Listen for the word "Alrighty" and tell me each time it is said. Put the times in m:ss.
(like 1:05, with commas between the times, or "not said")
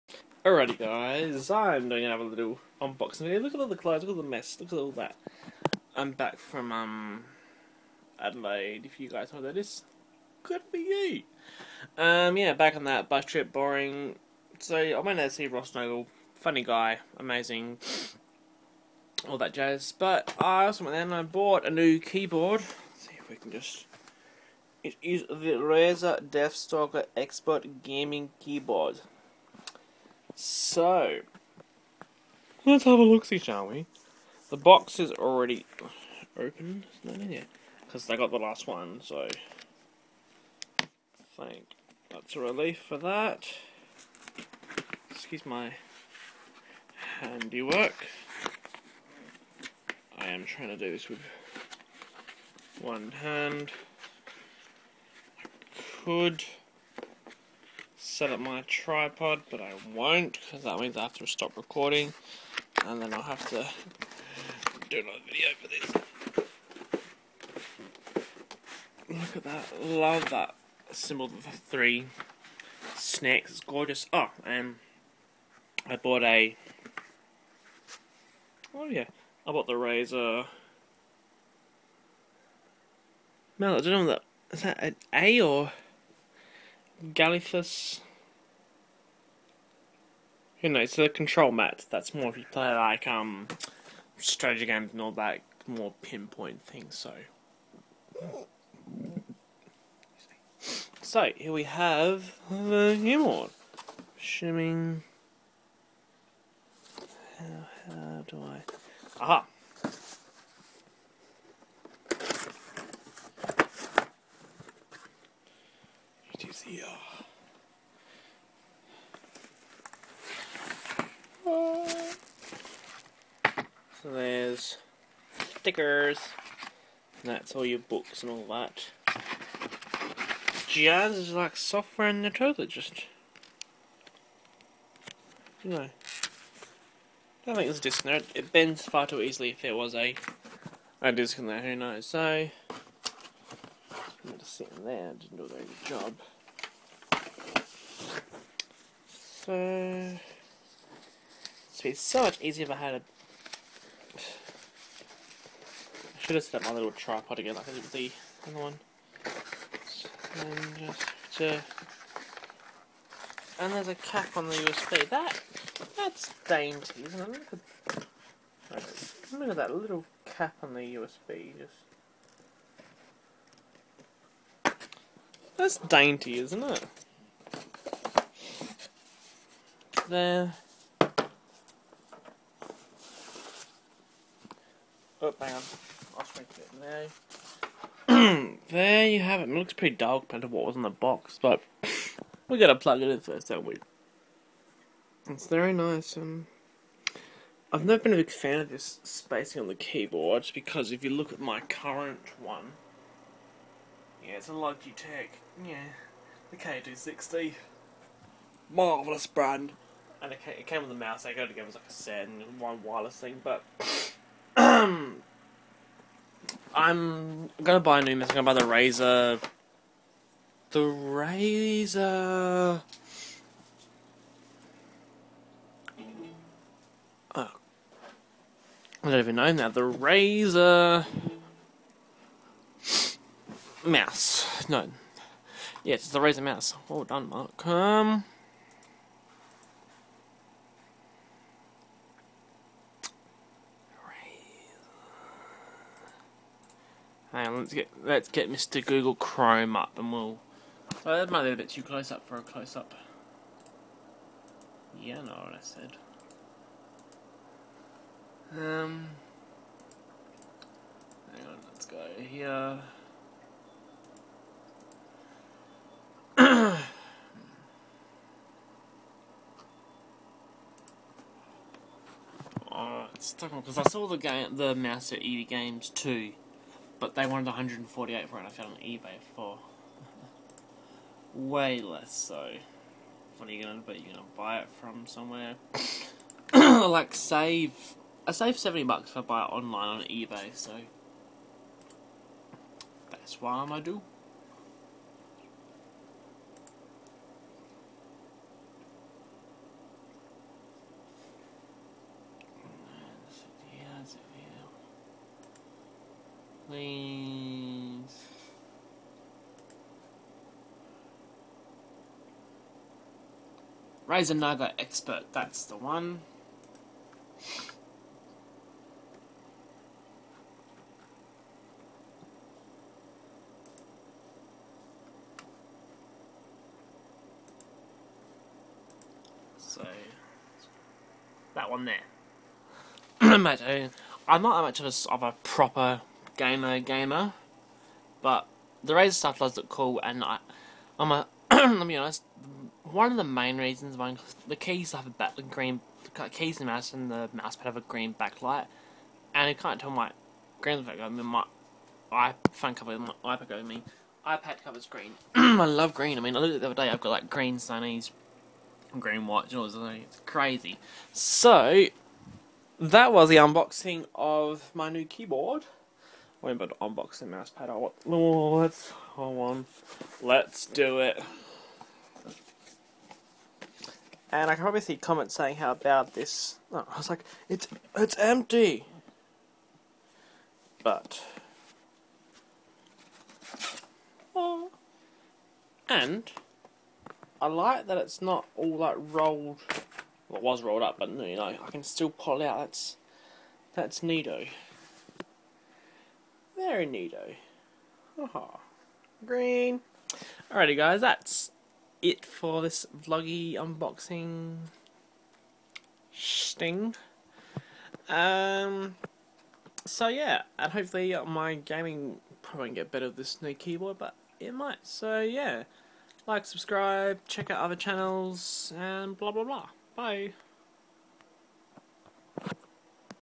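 0:00, 6:40.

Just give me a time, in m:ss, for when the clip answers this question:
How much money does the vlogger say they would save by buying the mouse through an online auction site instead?
4:48.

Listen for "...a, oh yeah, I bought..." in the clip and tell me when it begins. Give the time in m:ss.
1:16.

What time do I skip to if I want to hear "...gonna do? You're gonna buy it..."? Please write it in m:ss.
4:43.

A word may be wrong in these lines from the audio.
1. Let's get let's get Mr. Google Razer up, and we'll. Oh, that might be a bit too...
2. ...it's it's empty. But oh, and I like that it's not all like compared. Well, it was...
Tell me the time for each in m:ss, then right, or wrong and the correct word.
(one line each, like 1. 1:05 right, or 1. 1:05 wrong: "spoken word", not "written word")
1. 4:07 wrong: "Chrome", not "Razer"
2. 6:17 wrong: "rolled", not "compared".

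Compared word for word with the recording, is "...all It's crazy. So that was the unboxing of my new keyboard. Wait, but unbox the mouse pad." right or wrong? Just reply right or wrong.
right.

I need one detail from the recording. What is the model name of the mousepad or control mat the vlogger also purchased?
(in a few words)
Goliathus.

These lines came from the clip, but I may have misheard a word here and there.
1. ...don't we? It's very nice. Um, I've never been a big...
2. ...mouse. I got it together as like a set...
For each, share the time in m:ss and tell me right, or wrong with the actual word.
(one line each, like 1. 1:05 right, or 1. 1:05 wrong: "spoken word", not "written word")
1. 3:13 right
2. 3:30 right.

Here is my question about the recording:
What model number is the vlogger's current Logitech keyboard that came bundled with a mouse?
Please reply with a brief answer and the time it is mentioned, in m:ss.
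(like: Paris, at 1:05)
K260, at 3:26.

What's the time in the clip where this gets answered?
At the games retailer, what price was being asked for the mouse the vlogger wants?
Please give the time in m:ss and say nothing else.
4:37.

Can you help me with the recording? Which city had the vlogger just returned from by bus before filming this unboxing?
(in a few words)
Adelaide.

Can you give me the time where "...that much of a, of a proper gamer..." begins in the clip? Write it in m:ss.
5:33.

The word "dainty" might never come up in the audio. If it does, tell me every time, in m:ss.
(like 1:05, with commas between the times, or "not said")
2:46, 2:55.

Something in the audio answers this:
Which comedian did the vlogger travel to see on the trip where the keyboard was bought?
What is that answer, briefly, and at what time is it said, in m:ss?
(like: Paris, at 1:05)
Ross Noble, at 0:15.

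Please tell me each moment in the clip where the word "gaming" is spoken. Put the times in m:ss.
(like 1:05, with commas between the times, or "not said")
0:27, 6:51.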